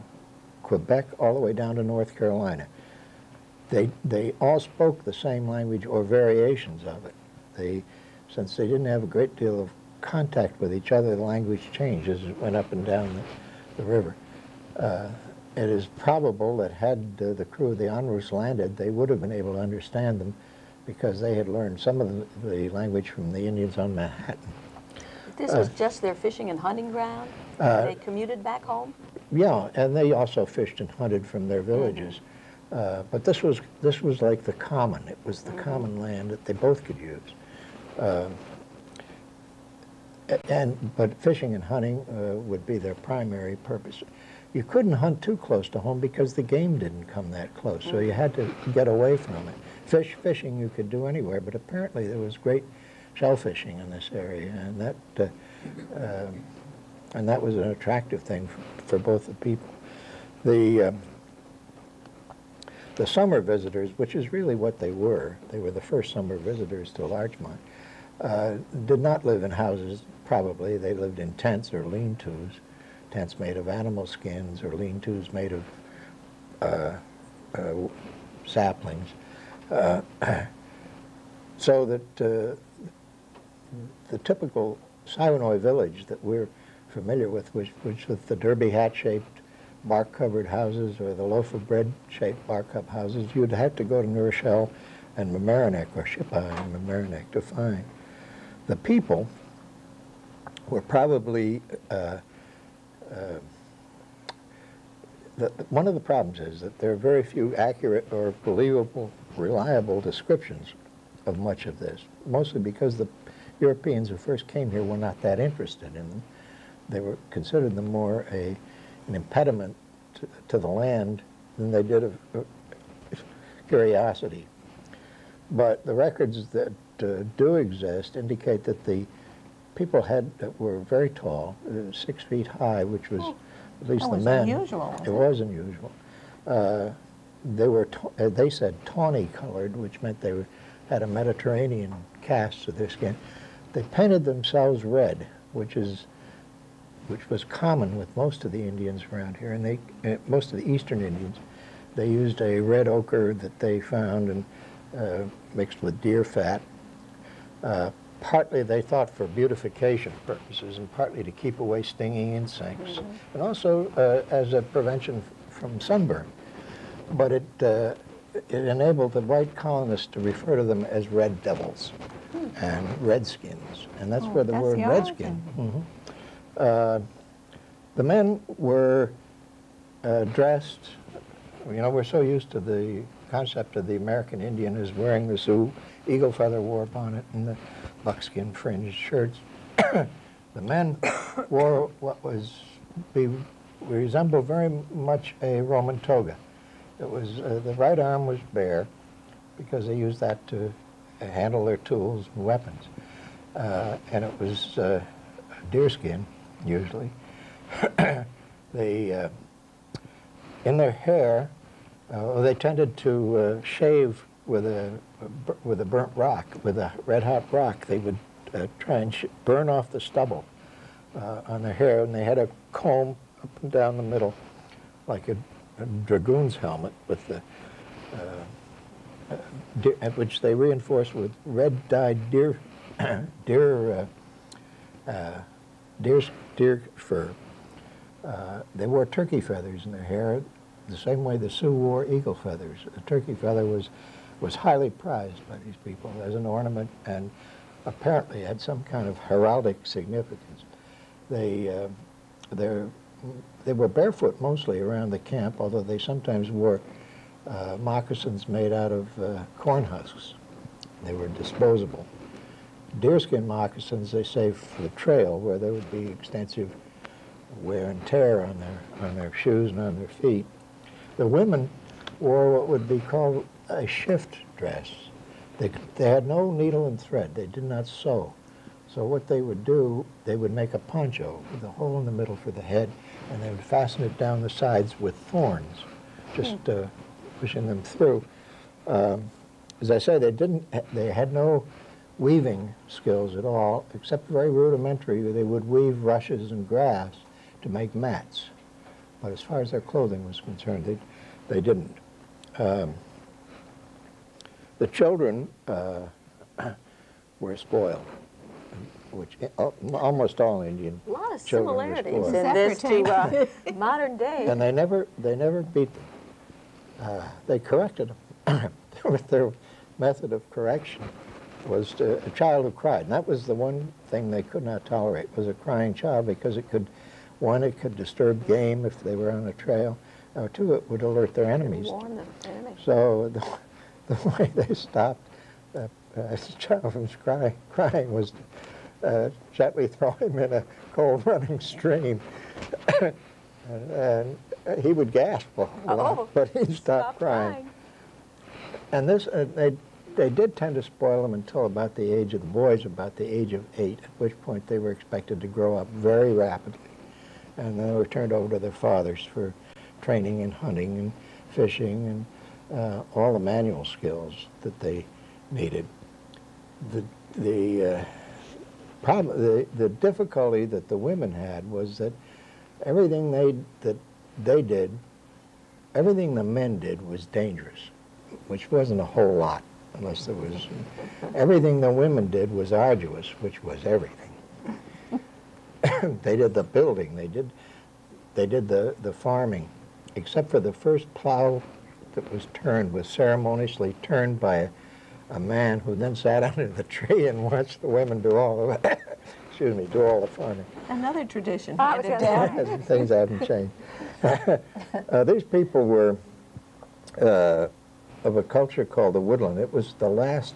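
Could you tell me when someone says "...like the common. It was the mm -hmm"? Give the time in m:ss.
0:34.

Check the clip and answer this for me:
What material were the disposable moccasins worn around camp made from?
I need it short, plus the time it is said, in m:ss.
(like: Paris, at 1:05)
corn husks, at 4:19.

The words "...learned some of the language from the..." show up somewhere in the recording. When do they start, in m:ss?
0:21.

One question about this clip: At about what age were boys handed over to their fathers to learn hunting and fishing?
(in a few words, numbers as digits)
8.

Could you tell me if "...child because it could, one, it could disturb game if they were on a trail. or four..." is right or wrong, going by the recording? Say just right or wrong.
wrong.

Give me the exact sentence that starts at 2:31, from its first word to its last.
They used a red ochre that they found and uh, mixed with deer fat.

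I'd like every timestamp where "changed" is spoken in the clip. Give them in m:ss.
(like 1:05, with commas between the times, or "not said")
0:11, 6:43.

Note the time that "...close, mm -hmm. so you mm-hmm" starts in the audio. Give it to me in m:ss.
0:47.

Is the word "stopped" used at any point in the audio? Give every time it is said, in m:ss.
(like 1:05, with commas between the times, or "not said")
5:34, 5:46.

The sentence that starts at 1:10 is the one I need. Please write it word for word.
They lived in tents or lean-tos, tents made of animal skins or lean-tos made of uh, uh, saplings.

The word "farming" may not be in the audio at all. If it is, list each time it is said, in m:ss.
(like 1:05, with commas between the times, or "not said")
6:29, 6:40.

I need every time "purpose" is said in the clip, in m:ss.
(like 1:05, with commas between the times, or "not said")
0:43, 2:40.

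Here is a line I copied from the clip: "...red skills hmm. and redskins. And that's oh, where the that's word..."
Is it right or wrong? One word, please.
wrong.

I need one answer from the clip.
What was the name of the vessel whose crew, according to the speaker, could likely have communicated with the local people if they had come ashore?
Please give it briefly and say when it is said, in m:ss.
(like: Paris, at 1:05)
Onrust, at 0:17.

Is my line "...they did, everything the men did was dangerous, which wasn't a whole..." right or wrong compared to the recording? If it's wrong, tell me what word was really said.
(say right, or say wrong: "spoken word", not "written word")
right.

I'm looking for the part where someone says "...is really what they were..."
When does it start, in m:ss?
1:04.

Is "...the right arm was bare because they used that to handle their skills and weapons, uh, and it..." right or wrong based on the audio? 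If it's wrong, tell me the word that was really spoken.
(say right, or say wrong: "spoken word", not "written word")
wrong: "tools", not "skills".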